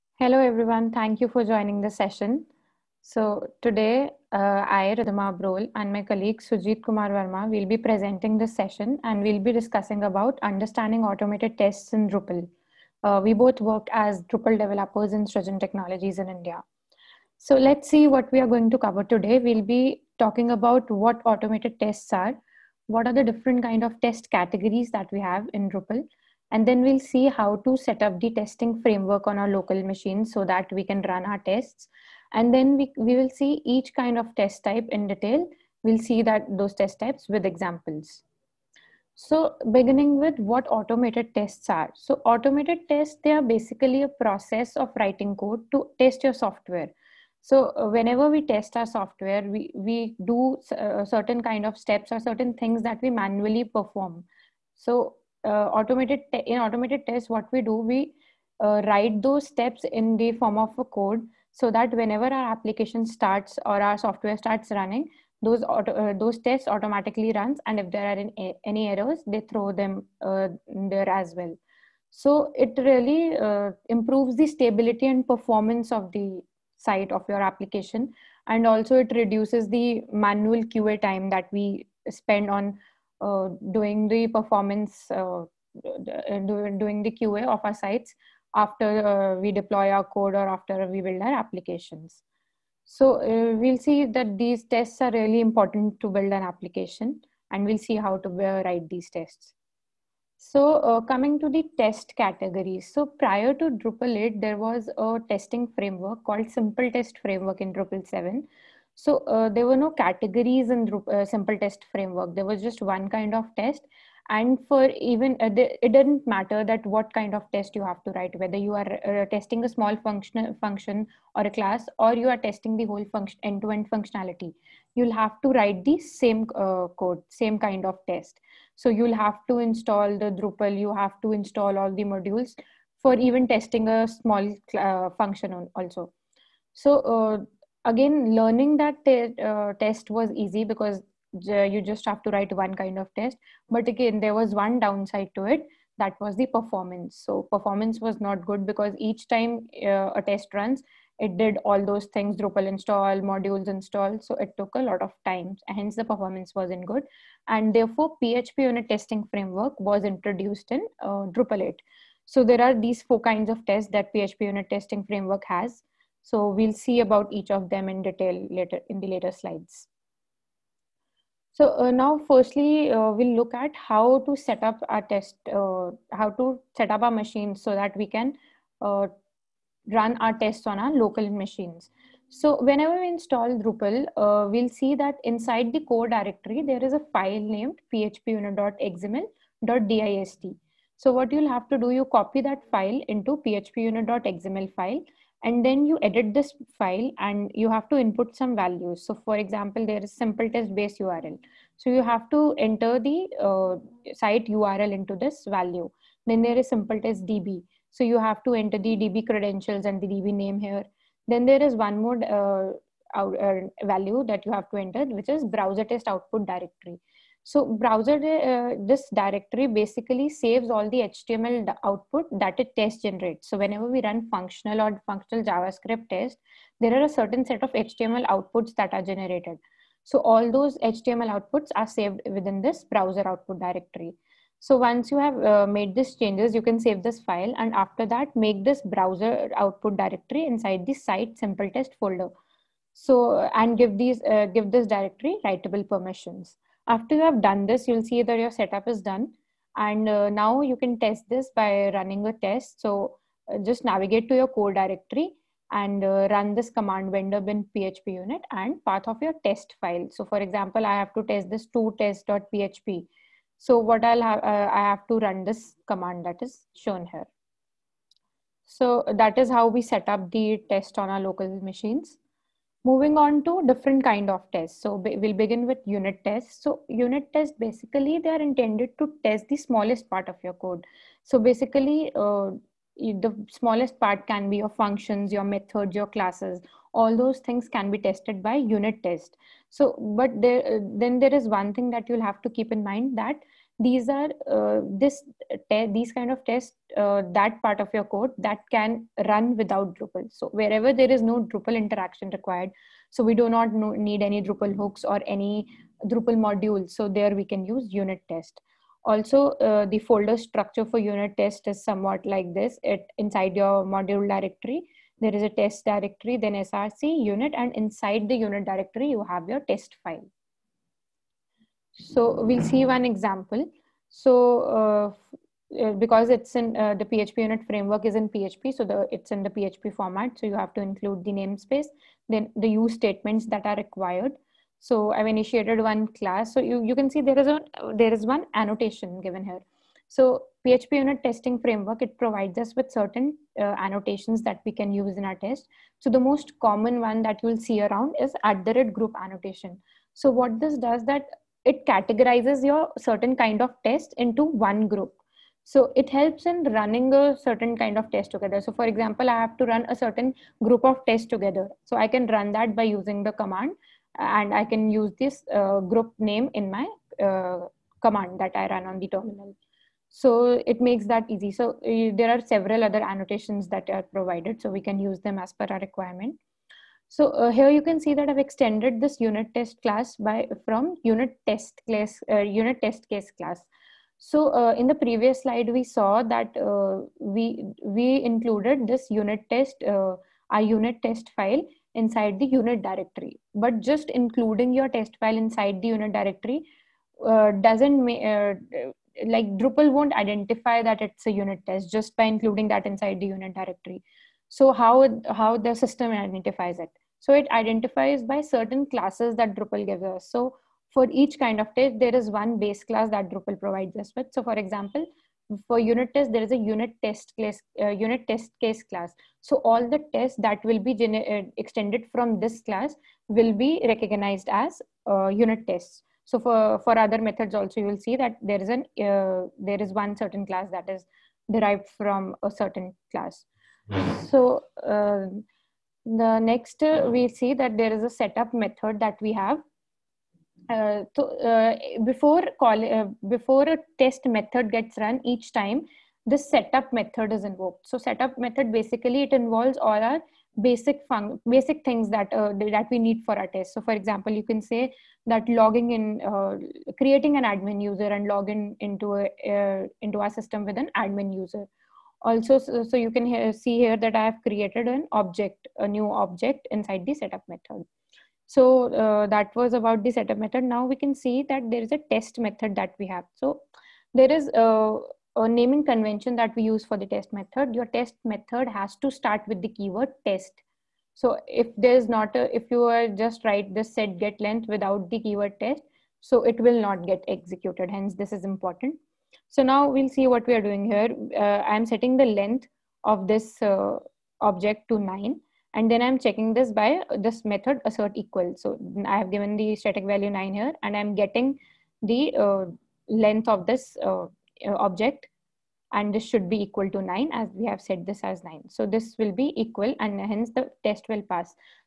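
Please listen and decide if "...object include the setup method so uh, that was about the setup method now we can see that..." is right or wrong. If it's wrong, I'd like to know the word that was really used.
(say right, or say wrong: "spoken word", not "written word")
wrong: "inside", not "include".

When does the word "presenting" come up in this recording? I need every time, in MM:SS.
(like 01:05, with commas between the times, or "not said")
00:07.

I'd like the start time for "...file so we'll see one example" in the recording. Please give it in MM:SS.
05:20.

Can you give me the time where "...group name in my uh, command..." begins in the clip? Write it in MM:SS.
06:05.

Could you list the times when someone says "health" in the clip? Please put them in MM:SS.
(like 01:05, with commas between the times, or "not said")
not said.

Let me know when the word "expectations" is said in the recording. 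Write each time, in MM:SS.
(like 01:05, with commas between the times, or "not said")
not said.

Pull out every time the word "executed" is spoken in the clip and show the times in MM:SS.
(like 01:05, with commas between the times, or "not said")
08:07.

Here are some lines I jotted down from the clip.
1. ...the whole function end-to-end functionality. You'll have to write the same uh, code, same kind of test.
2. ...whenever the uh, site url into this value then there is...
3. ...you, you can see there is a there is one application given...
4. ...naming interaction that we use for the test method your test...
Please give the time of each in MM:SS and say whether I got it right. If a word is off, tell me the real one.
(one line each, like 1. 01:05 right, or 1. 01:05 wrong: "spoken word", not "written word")
1. 02:02 right
2. 03:22 wrong: "enter", not "whenever"
3. 05:36 wrong: "annotation", not "application"
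4. 07:55 wrong: "convention", not "interaction".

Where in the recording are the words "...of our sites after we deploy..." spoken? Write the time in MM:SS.
01:27.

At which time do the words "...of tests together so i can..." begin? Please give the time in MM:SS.
06:00.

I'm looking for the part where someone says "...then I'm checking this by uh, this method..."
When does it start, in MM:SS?
08:15.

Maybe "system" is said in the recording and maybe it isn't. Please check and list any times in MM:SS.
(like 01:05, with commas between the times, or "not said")
06:45, 07:40.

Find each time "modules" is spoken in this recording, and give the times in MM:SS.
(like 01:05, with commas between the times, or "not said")
02:12, 02:33, 05:06, 05:13.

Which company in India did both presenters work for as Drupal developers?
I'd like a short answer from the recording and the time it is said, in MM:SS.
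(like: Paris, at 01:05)
Srijan Technologies, at 00:15.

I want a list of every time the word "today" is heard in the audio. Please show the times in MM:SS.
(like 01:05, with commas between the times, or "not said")
00:03, 00:19.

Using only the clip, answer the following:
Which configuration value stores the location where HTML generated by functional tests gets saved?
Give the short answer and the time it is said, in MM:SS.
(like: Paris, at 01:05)
browser test output directory, at 03:35.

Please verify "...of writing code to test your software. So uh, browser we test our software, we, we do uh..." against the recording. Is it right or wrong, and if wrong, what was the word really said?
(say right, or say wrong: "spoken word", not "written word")
wrong: "whenever", not "browser".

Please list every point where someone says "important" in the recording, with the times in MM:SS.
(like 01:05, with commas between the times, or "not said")
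01:35, 08:08.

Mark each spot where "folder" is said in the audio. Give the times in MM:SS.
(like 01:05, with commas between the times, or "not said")
04:01, 05:09.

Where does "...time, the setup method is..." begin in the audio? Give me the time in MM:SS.
07:25.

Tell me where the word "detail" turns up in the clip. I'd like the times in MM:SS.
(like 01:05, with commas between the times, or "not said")
00:35, 02:48.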